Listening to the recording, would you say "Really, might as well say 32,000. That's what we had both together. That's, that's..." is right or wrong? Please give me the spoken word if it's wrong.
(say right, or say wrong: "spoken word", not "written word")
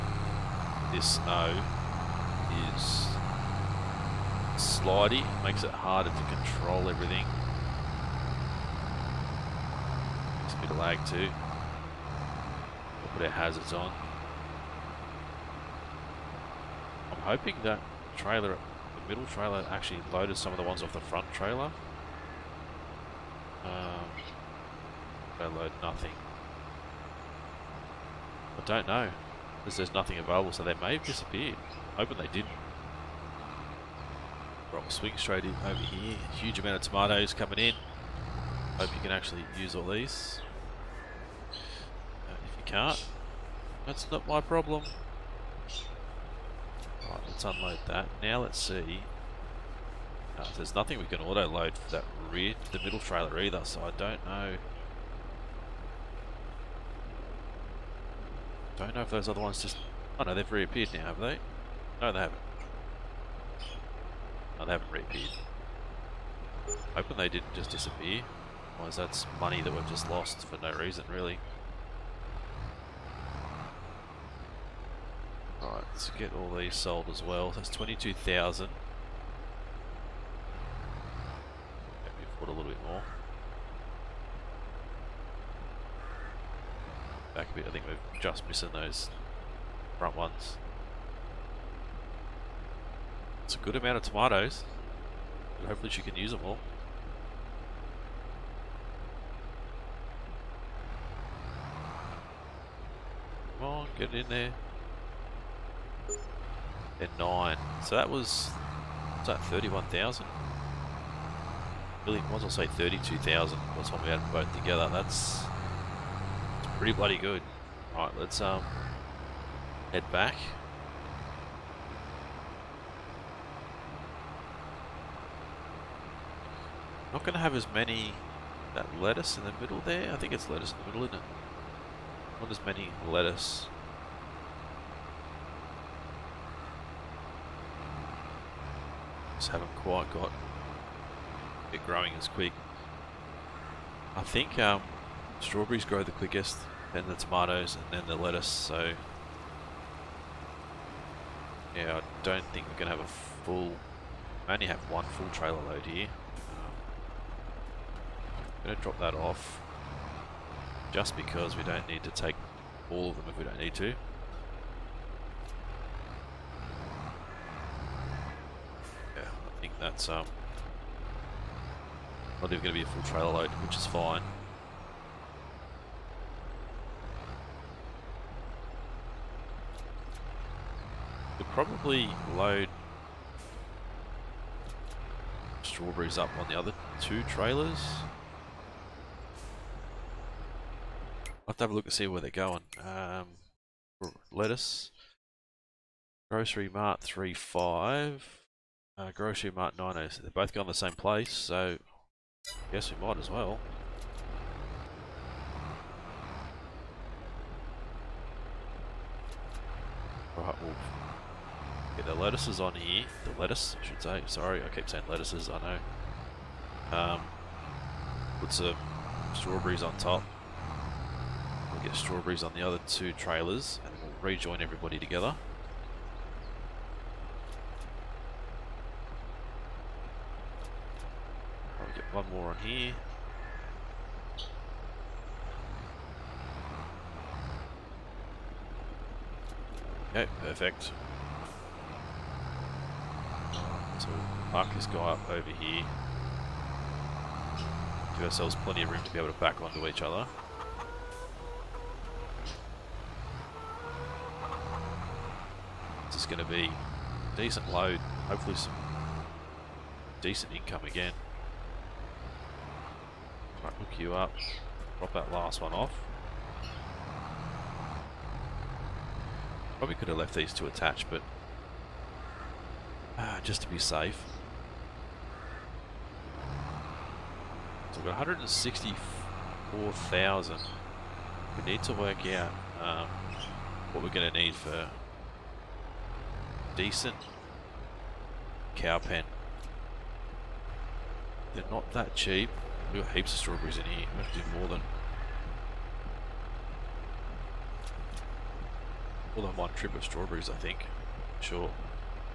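right.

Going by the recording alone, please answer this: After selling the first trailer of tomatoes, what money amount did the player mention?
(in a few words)
22,000.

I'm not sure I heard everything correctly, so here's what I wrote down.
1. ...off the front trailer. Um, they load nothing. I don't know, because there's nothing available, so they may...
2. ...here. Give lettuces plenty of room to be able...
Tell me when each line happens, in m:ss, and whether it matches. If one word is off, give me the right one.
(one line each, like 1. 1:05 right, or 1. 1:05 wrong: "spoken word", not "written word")
1. 0:20 right
2. 4:05 wrong: "ourselves", not "lettuces".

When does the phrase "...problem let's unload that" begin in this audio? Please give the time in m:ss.
0:44.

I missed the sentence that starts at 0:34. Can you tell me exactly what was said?
Rock swing straight in over here.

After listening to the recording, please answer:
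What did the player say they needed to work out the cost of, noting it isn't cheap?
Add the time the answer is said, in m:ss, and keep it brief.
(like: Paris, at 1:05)
cow pen, at 4:48.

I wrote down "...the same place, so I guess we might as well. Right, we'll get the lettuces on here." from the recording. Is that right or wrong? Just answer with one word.
right.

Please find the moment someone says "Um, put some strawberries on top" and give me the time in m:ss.
3:36.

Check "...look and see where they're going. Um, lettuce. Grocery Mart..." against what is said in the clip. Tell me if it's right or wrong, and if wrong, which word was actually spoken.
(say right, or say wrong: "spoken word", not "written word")
right.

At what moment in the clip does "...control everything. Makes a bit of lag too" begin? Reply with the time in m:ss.
0:06.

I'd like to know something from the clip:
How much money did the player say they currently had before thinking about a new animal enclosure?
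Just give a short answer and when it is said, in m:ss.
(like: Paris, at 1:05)
164,000, at 4:38.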